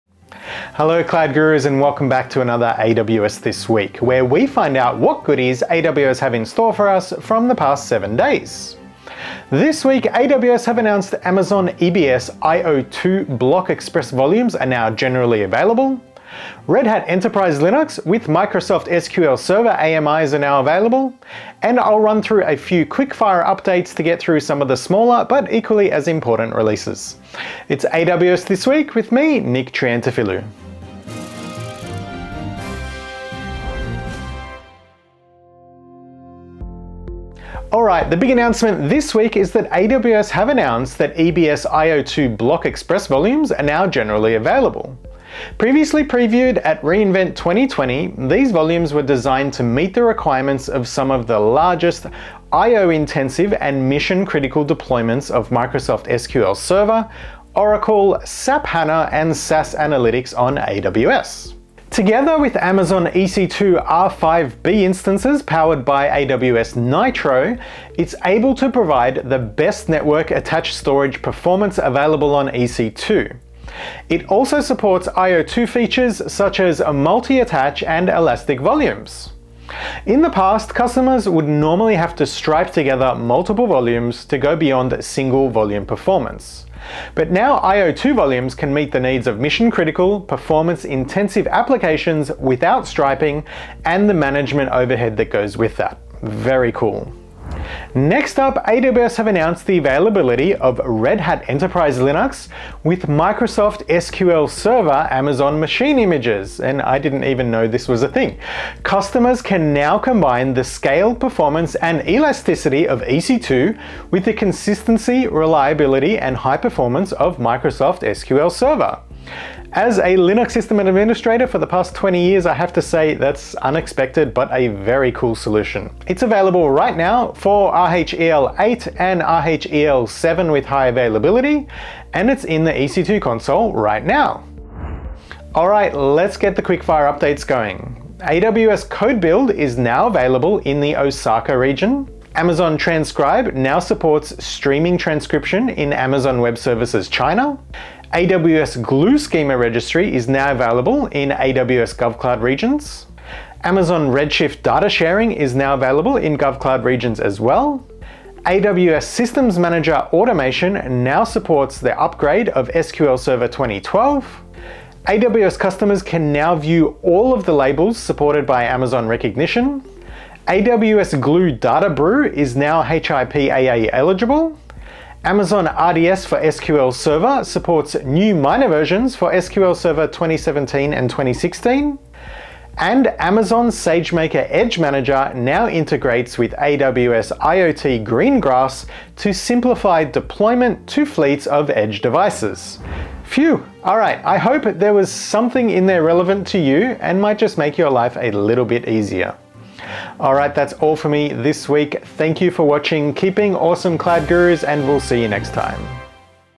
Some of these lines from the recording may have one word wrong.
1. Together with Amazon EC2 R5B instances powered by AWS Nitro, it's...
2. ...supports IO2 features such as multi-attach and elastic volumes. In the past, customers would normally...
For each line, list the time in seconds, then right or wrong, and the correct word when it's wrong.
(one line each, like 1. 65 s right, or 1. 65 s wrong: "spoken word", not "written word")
1. 61 s right
2. 74 s right.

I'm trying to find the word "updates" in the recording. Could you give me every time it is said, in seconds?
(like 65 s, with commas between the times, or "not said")
23 s, 137 s.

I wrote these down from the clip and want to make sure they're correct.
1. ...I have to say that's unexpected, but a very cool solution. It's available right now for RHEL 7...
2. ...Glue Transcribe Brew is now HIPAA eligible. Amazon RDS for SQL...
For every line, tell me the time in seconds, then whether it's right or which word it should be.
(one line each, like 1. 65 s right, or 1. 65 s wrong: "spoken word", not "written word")
1. 122 s wrong: "8", not "7"
2. 171 s wrong: "Data", not "Transcribe".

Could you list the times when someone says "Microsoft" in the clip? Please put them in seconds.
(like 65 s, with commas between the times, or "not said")
18 s, 55 s, 103 s, 117 s.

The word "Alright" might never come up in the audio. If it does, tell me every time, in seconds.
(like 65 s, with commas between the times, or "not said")
37 s, 193 s.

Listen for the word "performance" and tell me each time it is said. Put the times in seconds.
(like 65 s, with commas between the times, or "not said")
71 s, 85 s, 90 s, 111 s, 116 s.